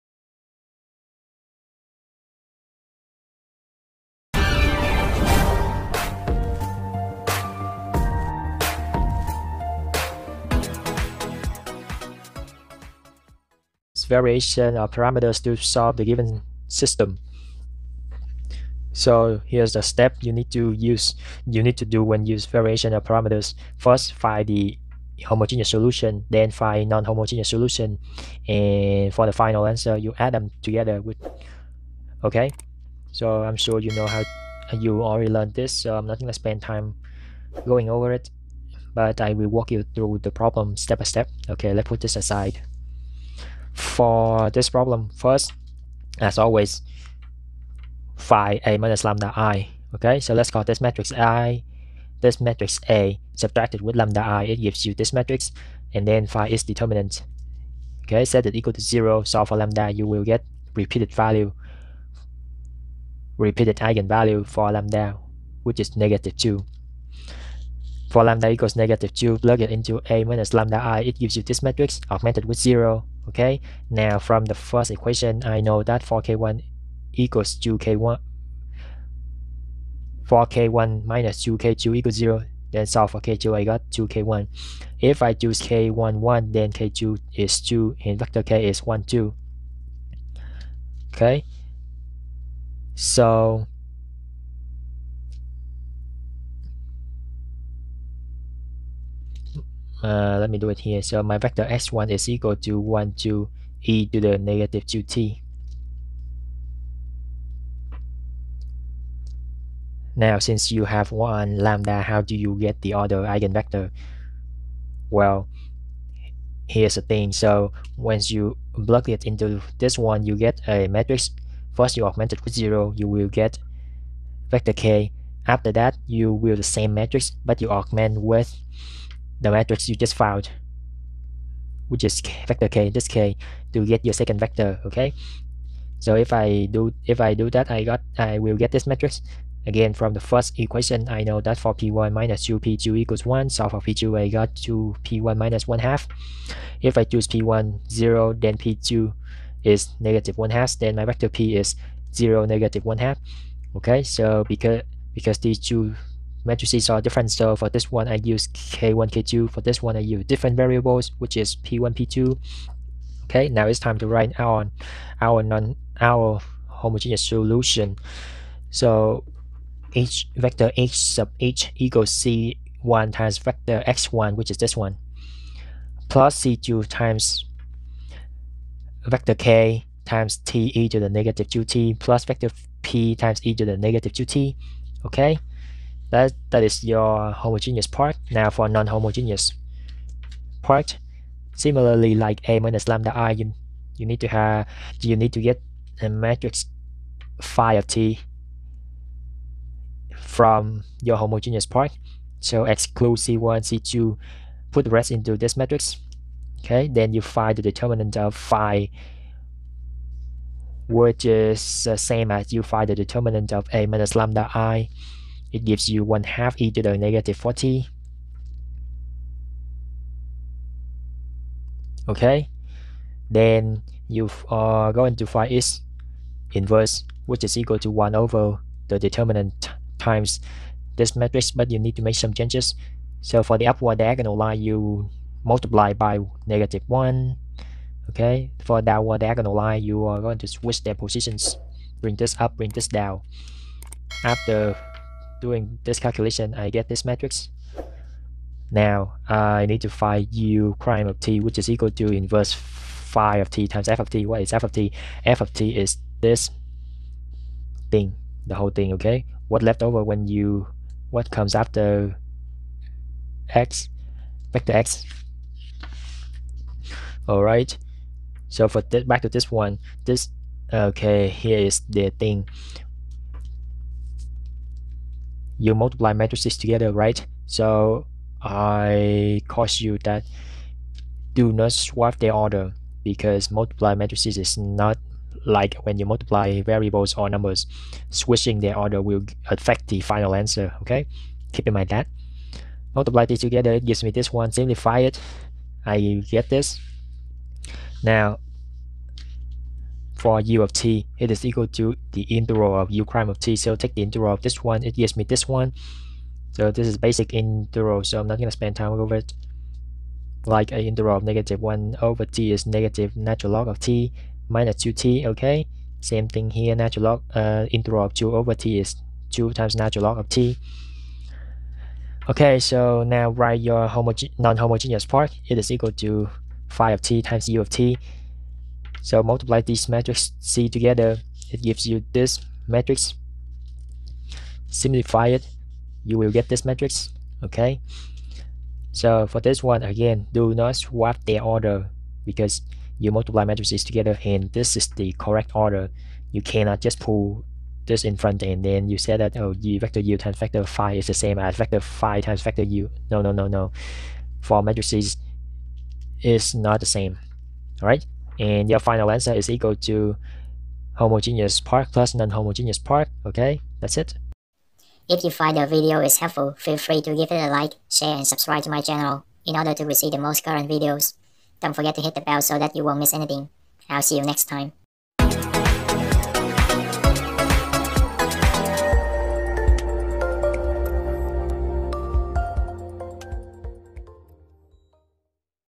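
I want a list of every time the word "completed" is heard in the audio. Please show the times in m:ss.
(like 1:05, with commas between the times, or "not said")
not said.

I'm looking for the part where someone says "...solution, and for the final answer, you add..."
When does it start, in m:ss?
0:27.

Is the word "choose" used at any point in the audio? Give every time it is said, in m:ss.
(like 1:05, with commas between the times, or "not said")
1:25, 2:27.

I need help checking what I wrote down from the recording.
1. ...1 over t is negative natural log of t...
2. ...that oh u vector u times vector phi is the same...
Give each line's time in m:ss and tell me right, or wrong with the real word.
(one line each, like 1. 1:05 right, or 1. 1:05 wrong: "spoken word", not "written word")
1. 5:11 right
2. 5:49 right.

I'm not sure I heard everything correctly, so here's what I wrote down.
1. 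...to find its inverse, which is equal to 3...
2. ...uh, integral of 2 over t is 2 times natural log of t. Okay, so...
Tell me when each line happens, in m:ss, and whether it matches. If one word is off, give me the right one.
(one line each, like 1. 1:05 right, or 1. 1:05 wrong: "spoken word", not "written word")
1. 3:45 wrong: "1", not "3"
2. 5:17 right.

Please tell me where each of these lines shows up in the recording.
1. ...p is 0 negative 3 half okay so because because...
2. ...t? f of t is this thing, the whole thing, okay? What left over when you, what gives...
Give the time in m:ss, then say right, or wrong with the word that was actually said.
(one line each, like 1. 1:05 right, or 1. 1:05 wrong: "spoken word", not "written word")
1. 2:31 wrong: "1", not "3"
2. 4:14 wrong: "comes", not "gives".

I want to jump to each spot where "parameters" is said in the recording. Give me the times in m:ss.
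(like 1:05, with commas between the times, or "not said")
0:14, 0:23.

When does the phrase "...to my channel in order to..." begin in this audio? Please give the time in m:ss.
6:08.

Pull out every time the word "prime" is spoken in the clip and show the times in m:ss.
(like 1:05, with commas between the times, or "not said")
4:10, 5:03.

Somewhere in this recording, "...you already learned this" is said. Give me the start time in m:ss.
0:34.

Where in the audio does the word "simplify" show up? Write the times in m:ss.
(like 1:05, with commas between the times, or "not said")
4:54, 5:34.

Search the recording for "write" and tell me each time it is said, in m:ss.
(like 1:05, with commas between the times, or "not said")
2:44, 5:23.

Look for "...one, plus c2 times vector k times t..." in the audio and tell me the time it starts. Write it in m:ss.
2:54.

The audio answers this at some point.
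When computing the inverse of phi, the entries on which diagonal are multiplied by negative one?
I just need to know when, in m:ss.
3:53.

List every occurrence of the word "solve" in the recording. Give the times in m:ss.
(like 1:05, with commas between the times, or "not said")
0:15, 0:59, 1:22.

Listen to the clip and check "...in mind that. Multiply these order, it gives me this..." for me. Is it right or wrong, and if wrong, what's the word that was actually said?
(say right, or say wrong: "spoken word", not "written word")
wrong: "together", not "order".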